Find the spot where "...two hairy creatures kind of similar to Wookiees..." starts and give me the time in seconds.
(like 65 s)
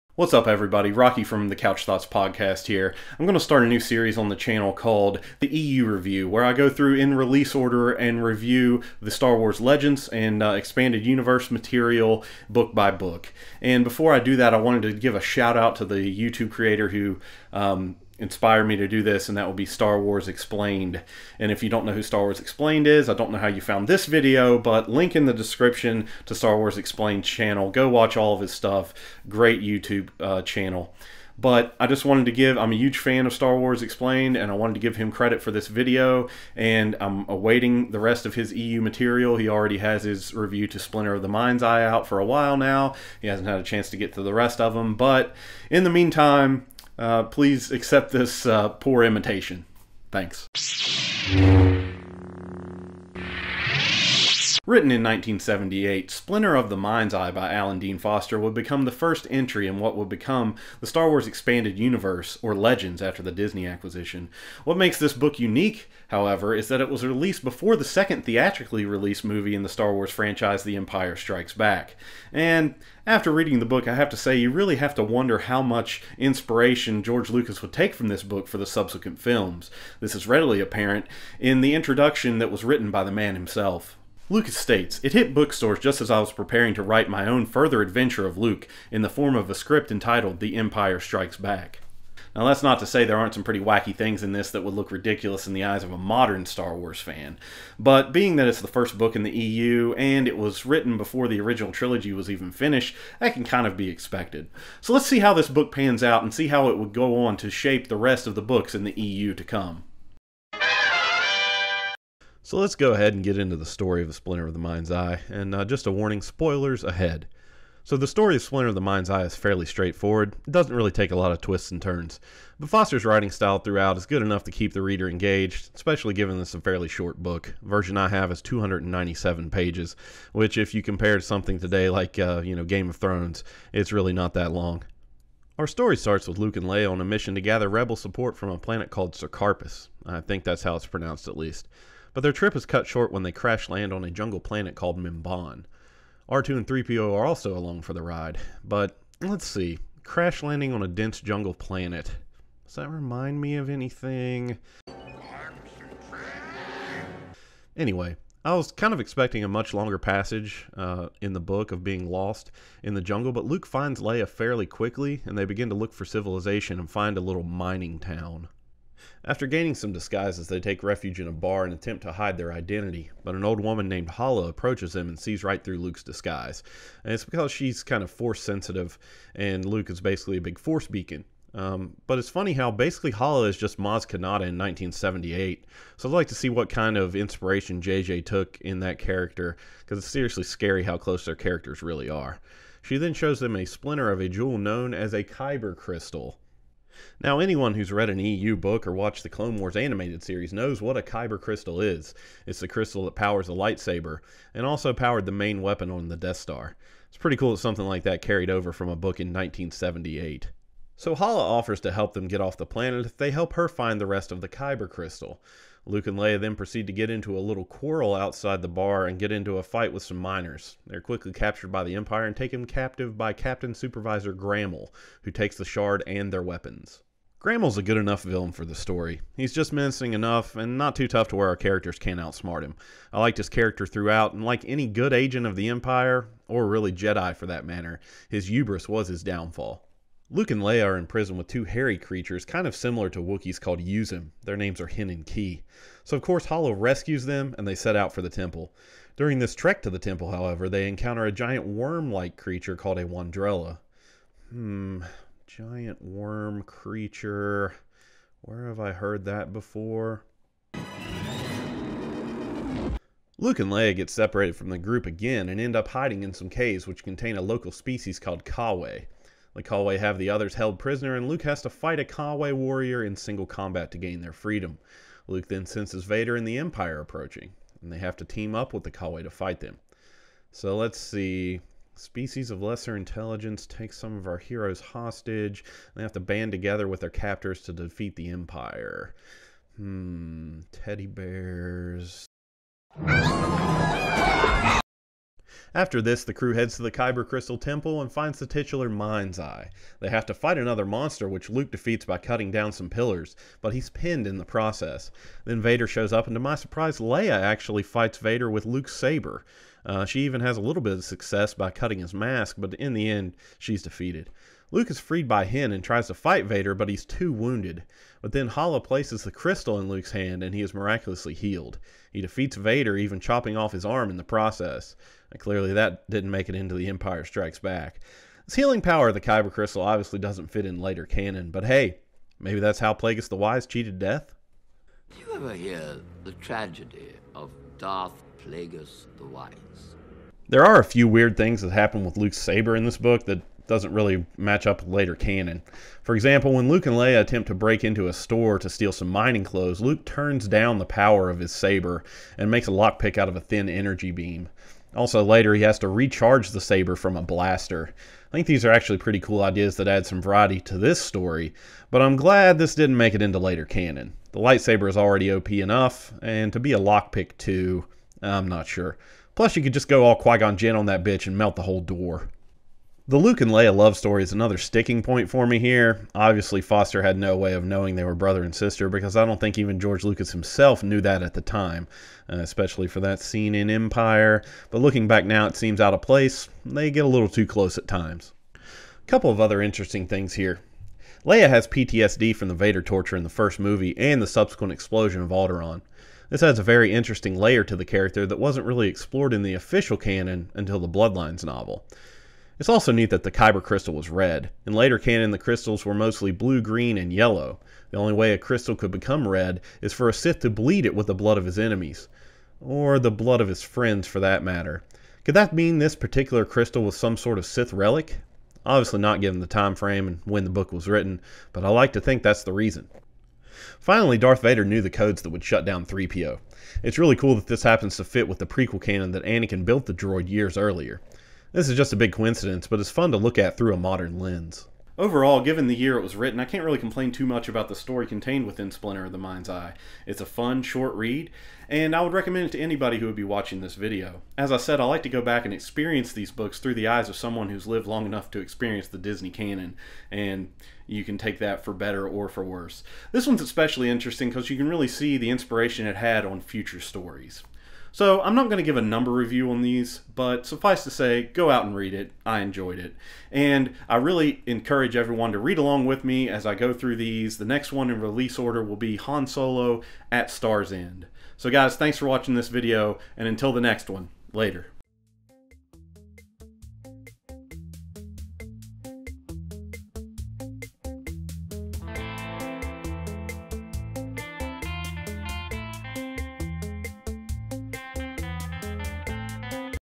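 241 s.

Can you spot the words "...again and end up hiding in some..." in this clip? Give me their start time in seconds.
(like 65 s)
265 s.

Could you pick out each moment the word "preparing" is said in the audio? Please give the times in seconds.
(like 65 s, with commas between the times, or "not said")
86 s.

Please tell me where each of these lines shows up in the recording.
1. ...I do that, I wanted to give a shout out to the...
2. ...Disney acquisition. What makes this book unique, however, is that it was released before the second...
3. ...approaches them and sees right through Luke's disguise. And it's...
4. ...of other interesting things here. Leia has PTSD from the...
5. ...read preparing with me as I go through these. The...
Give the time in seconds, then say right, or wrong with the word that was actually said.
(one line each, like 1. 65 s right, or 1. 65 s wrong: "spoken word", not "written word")
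1. 14 s right
2. 63 s right
3. 174 s right
4. 389 s right
5. 465 s wrong: "along", not "preparing".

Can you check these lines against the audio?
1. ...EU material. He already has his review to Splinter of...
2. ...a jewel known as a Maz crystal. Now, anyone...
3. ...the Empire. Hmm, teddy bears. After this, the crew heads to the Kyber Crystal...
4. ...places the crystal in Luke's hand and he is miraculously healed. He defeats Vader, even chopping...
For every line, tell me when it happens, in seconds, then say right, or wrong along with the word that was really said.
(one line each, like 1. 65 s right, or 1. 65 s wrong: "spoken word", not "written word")
1. 38 s right
2. 194 s wrong: "Kyber", not "Maz"
3. 288 s right
4. 318 s right.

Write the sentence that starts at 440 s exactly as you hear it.
It's a fun, short read, and I would recommend it to anybody who would be watching this video.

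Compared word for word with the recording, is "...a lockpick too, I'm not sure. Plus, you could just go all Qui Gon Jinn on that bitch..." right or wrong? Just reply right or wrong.
right.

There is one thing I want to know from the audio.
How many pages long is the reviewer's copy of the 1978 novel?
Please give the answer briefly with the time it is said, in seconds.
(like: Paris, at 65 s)
297, at 128 s.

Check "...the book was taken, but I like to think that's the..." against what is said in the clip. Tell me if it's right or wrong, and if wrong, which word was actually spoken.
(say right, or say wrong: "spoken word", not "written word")
wrong: "written", not "taken".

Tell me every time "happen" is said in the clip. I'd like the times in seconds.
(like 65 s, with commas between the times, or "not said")
341 s, 427 s.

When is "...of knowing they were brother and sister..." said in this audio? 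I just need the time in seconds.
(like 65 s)
377 s.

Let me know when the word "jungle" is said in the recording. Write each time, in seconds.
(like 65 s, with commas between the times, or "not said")
144 s, 151 s, 163 s.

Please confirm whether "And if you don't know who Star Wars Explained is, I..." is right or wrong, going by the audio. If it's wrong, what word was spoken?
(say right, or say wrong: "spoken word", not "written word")
right.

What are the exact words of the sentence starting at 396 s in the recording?
This adds a very interesting layer to the character that wasn't really explored in the official canon until the Bloodlines novel.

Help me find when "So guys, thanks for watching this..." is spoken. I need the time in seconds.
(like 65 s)
471 s.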